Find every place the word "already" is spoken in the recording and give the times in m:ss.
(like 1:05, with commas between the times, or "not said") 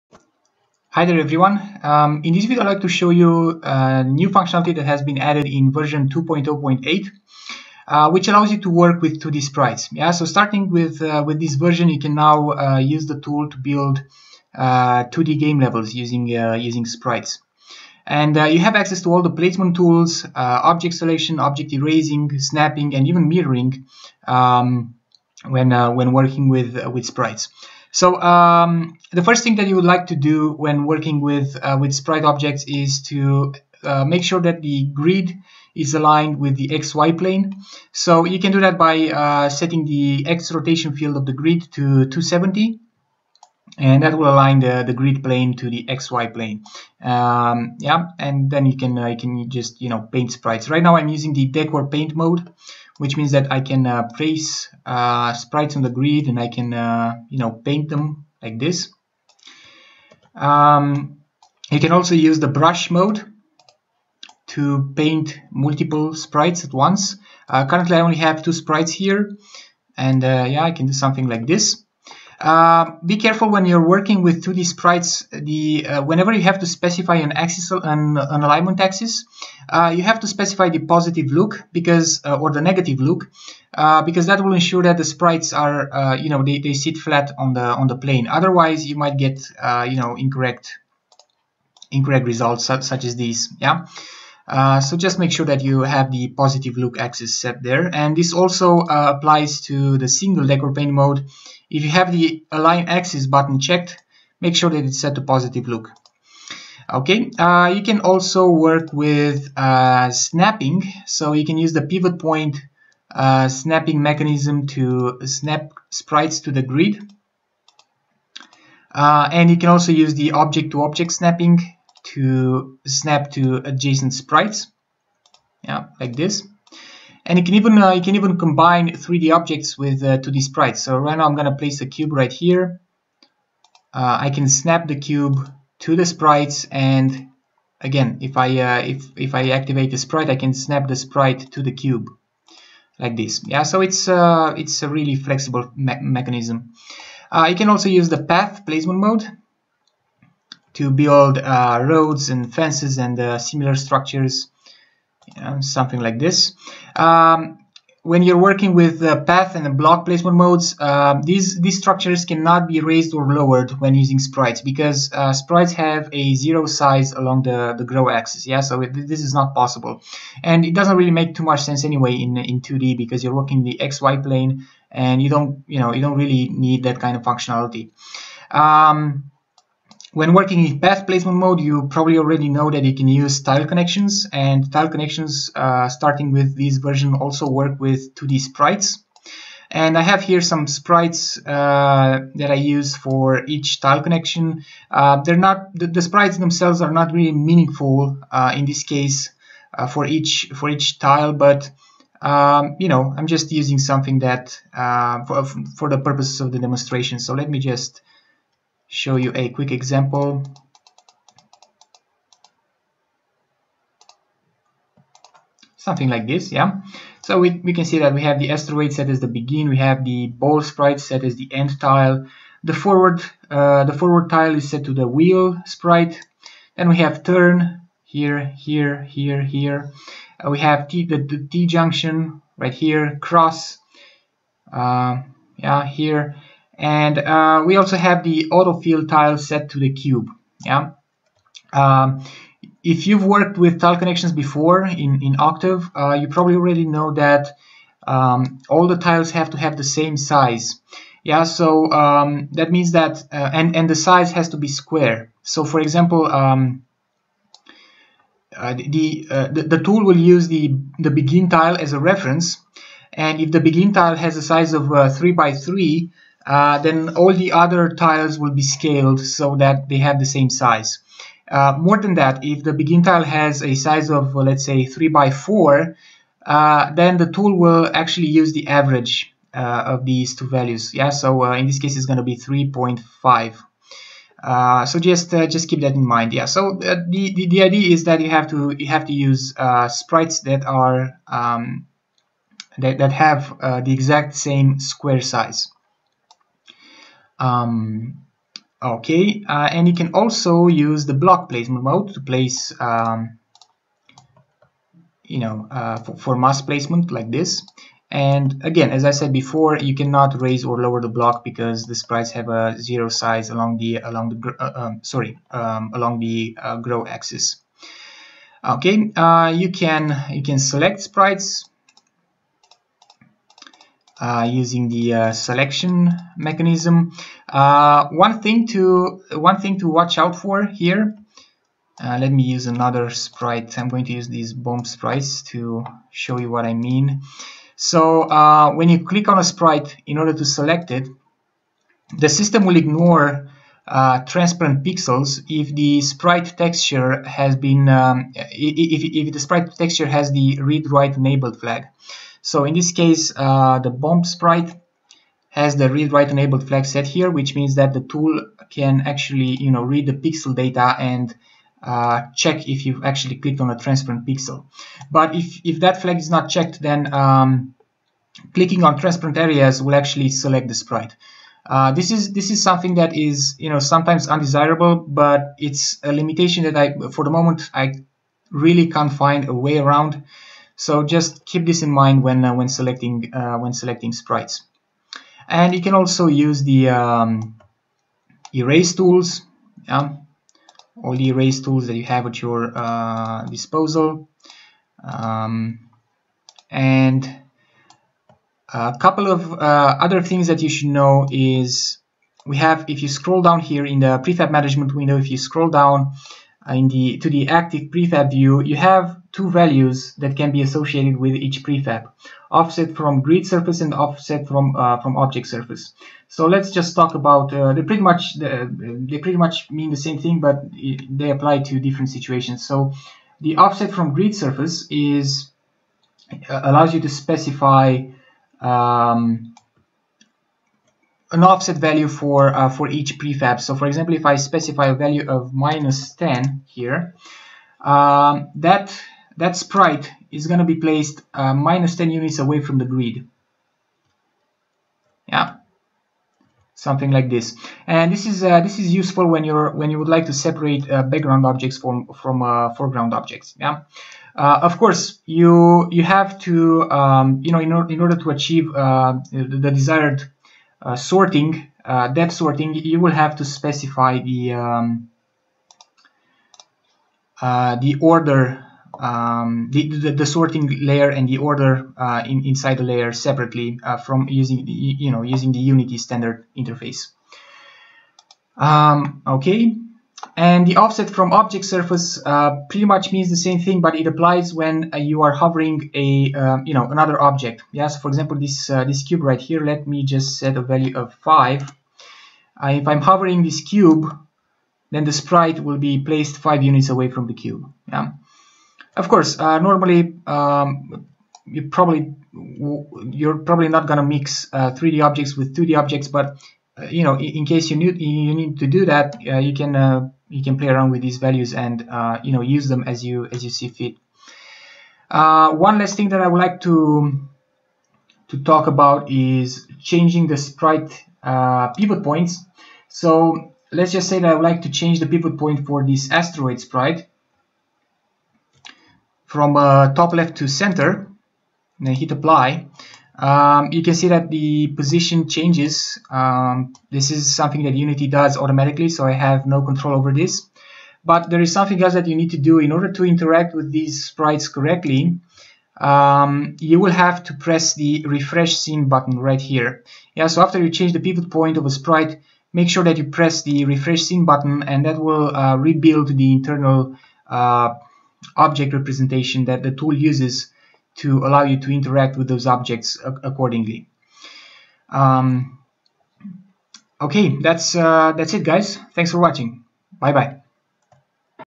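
3:02, 4:06.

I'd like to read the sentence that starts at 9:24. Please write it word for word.
Um, okay, that's, uh, that's it guys.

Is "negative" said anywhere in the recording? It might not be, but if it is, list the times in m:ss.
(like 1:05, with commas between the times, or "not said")
1:22.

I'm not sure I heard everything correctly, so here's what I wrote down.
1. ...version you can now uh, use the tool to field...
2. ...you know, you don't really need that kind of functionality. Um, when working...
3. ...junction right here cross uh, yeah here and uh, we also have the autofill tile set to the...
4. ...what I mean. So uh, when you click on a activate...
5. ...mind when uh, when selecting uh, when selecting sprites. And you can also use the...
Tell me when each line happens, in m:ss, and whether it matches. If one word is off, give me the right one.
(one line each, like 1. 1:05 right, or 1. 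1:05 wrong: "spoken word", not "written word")
1. 0:11 wrong: "build", not "field"
2. 2:55 right
3. 3:51 right
4. 5:36 wrong: "sprite", not "activate"
5. 6:21 right.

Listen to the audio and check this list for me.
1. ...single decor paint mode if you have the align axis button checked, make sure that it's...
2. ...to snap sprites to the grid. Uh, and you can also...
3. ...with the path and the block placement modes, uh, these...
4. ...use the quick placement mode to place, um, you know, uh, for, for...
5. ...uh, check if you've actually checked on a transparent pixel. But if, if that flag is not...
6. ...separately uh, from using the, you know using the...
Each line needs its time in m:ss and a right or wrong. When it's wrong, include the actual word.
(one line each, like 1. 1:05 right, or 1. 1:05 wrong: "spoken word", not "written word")
1. 1:40 right
2. 1:54 right
3. 2:38 right
4. 5:00 wrong: "block", not "quick"
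5. 6:01 wrong: "clicked", not "checked"
6. 7:53 right.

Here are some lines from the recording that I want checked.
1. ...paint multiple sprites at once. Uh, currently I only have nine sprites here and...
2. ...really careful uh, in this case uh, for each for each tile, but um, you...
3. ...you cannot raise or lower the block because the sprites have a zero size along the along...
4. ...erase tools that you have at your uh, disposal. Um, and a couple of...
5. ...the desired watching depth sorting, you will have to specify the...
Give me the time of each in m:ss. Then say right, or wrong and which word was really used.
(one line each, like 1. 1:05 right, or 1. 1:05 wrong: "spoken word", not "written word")
1. 1:04 wrong: "two", not "nine"
2. 3:17 wrong: "meaningful", not "careful"
3. 5:09 right
4. 6:31 right
5. 7:39 wrong: "sorting", not "watching".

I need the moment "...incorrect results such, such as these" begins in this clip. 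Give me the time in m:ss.
1:31.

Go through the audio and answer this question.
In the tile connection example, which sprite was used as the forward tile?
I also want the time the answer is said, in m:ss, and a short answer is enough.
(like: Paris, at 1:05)
the wheel sprite, at 3:45.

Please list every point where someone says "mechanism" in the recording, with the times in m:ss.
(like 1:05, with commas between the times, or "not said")
1:54, 2:26, 5:26.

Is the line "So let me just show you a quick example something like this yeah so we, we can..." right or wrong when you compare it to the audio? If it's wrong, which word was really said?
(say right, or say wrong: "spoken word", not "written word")
right.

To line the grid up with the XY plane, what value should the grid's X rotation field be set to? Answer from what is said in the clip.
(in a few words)
270.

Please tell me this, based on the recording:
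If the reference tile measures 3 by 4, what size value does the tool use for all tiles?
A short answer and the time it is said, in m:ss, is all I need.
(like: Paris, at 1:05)
3.5, at 4:42.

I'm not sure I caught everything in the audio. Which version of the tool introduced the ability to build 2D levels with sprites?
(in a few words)
2.0.8.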